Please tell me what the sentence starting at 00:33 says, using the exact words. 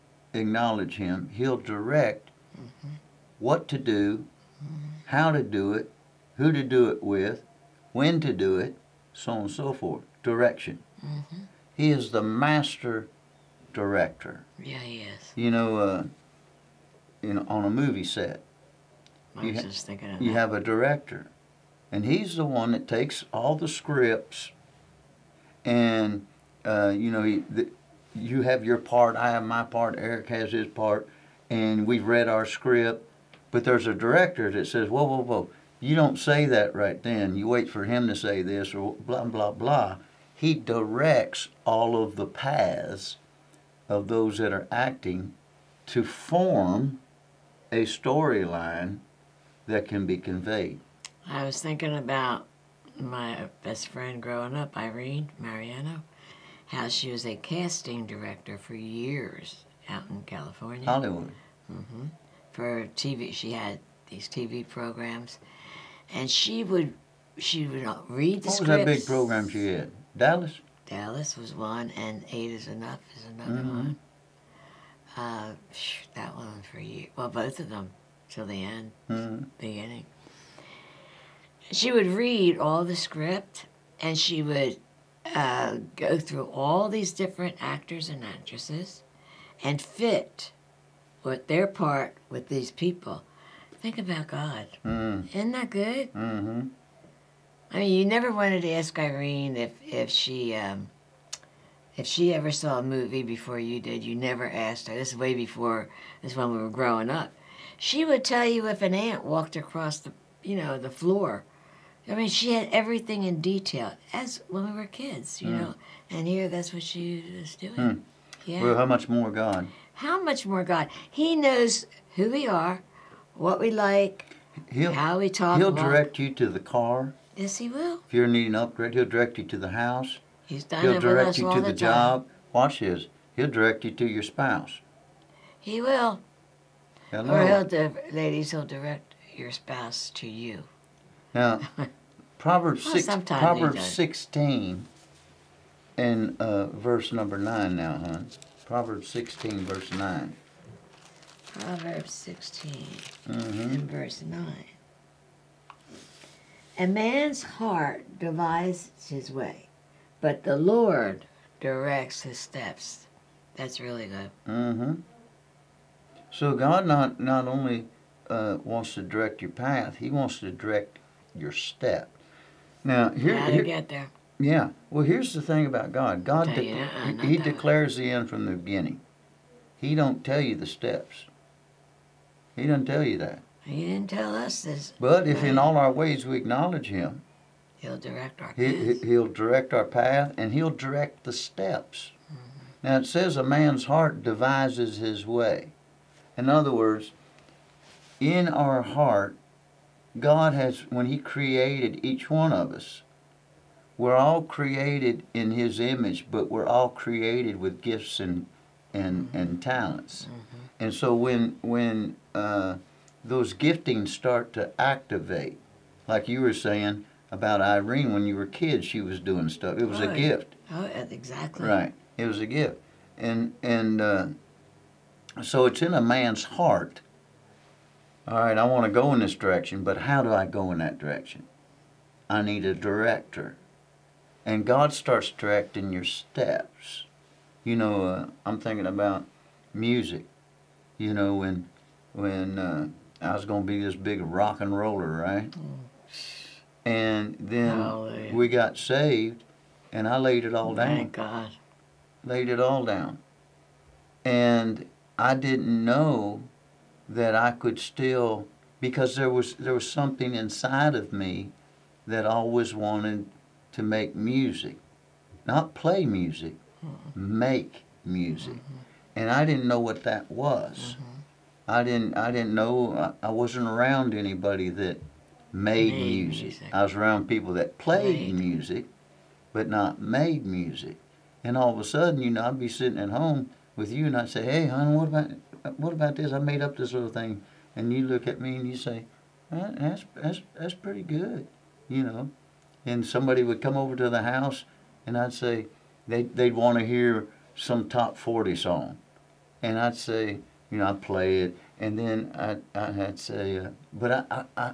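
But there's a director that says, whoa, whoa, whoa, you don't say that right then.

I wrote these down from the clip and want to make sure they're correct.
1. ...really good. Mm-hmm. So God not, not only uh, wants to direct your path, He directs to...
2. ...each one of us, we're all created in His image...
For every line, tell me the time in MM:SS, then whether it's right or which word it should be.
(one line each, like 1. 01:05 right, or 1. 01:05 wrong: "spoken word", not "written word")
1. 02:43 wrong: "wants", not "directs"
2. 03:22 right.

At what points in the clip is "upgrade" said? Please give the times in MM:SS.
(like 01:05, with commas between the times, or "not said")
02:08.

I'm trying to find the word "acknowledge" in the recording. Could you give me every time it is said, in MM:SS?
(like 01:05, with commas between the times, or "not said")
00:00, 03:06.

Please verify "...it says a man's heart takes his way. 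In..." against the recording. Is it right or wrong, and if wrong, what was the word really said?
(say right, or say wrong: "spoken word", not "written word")
wrong: "devises", not "takes".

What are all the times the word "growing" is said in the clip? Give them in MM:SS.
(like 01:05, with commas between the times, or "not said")
00:54, 01:46.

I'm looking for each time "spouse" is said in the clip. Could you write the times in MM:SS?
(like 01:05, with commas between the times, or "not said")
02:14, 02:19.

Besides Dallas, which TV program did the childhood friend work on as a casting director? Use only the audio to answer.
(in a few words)
Eight is Enough.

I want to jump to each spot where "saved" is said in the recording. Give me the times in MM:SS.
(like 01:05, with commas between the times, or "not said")
04:08.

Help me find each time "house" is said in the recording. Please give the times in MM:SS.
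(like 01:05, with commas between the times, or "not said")
02:09, 04:54.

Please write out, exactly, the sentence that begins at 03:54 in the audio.
And God starts directing your steps.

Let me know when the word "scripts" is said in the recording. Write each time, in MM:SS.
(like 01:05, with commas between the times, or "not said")
00:23, 00:32, 01:08, 01:22.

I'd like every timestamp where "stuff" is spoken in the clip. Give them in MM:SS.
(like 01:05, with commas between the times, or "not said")
03:39.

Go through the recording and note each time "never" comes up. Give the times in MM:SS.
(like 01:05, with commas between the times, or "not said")
01:38, 01:44.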